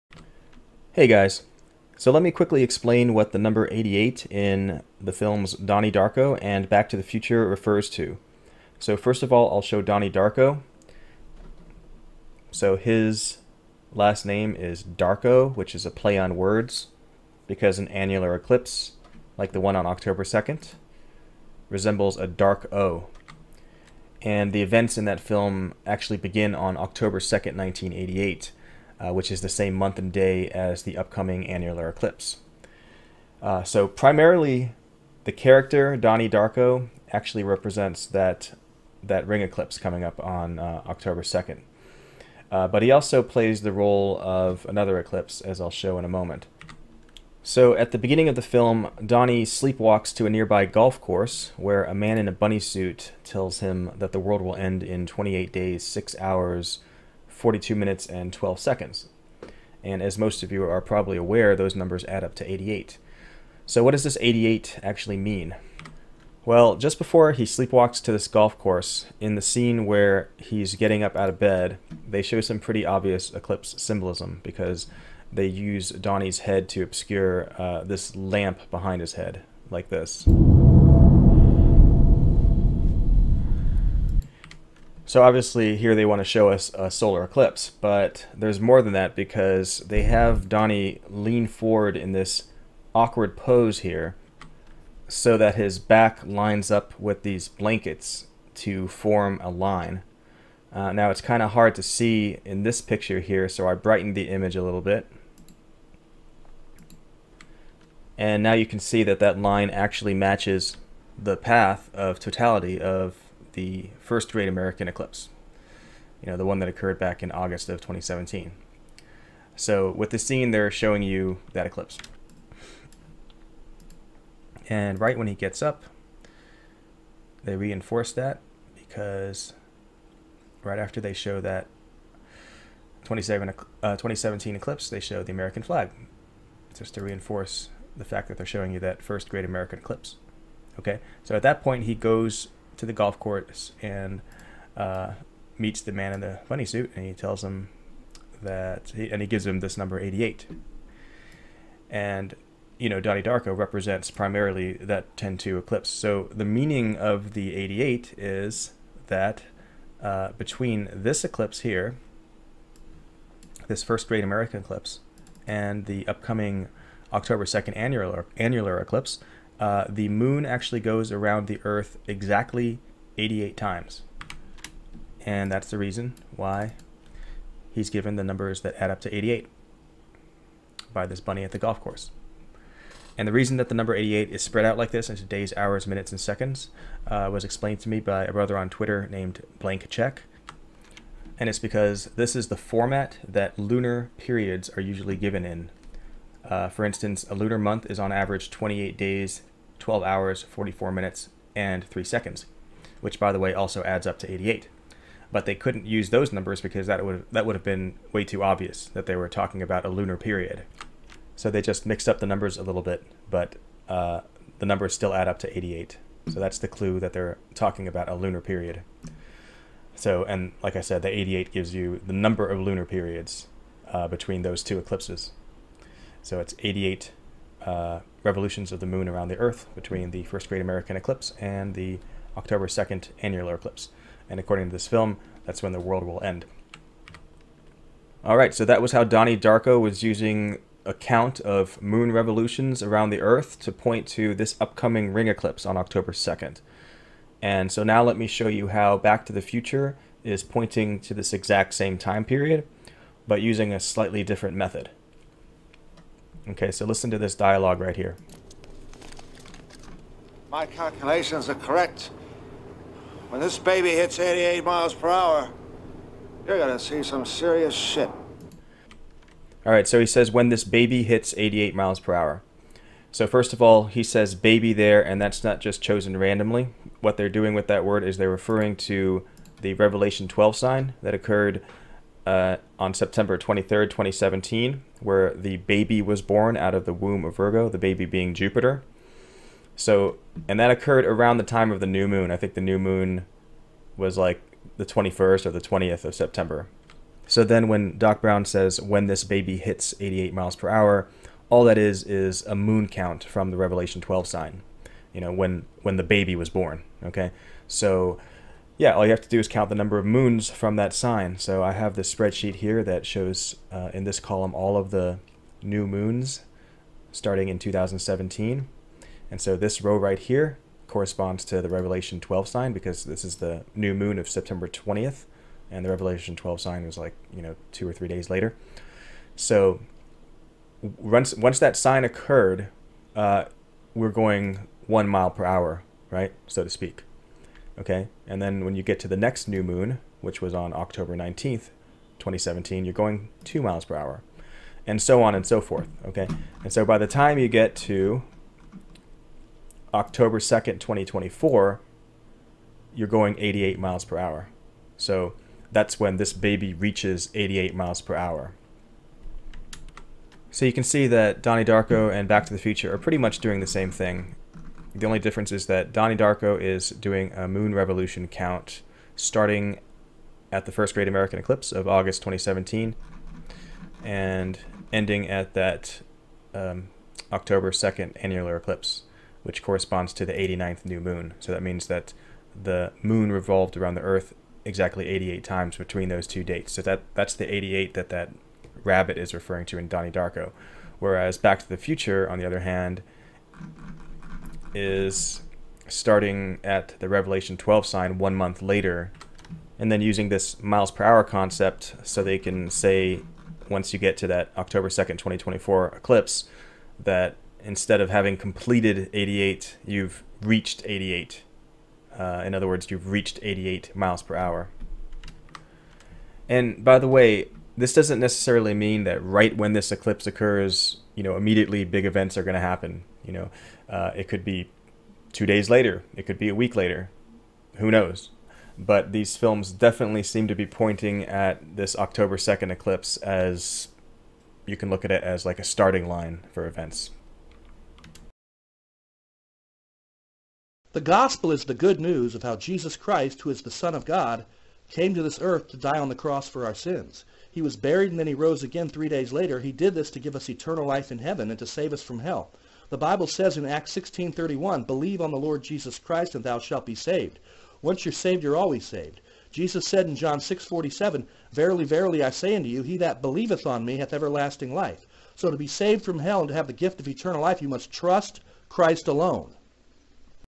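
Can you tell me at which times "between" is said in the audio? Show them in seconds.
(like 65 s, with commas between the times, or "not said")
160 s, 224 s, 229 s, 385 s.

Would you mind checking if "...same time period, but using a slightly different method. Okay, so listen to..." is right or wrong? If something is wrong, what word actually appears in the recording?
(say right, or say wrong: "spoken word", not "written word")
right.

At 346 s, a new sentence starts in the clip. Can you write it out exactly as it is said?
Okay, and so by the time you get to October 2nd, 2024, you're going 88 miles per hour.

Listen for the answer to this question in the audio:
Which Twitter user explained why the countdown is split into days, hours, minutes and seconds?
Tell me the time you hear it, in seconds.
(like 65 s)
189 s.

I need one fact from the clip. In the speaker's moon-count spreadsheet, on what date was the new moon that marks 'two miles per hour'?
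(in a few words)
October 19th, 2017.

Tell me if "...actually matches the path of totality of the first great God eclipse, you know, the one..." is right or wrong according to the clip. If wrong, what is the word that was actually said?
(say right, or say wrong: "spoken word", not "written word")
wrong: "American", not "God".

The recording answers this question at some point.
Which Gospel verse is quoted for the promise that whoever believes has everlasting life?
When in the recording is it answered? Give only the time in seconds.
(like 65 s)
460 s.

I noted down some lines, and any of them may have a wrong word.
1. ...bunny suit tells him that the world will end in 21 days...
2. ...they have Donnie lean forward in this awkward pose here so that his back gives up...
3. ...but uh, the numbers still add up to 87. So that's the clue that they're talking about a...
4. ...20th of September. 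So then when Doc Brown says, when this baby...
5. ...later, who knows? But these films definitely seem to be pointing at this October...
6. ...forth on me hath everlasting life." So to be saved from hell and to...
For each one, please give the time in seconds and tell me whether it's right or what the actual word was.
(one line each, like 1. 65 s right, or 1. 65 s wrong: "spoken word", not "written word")
1. 52 s wrong: "28", not "21"
2. 89 s wrong: "lines", not "gives"
3. 213 s wrong: "88", not "87"
4. 295 s right
5. 426 s right
6. 463 s wrong: "believeth", not "forth".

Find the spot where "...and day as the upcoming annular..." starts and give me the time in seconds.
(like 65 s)
29 s.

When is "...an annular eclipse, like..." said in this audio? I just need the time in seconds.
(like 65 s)
17 s.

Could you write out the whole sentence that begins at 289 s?
So, and that occurred around the time of the new moon.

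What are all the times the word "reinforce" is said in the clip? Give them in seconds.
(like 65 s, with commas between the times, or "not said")
127 s, 137 s.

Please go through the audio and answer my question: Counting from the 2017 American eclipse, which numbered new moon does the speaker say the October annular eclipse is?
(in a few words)
89th.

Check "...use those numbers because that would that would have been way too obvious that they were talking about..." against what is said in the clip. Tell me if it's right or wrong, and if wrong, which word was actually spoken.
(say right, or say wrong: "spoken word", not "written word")
right.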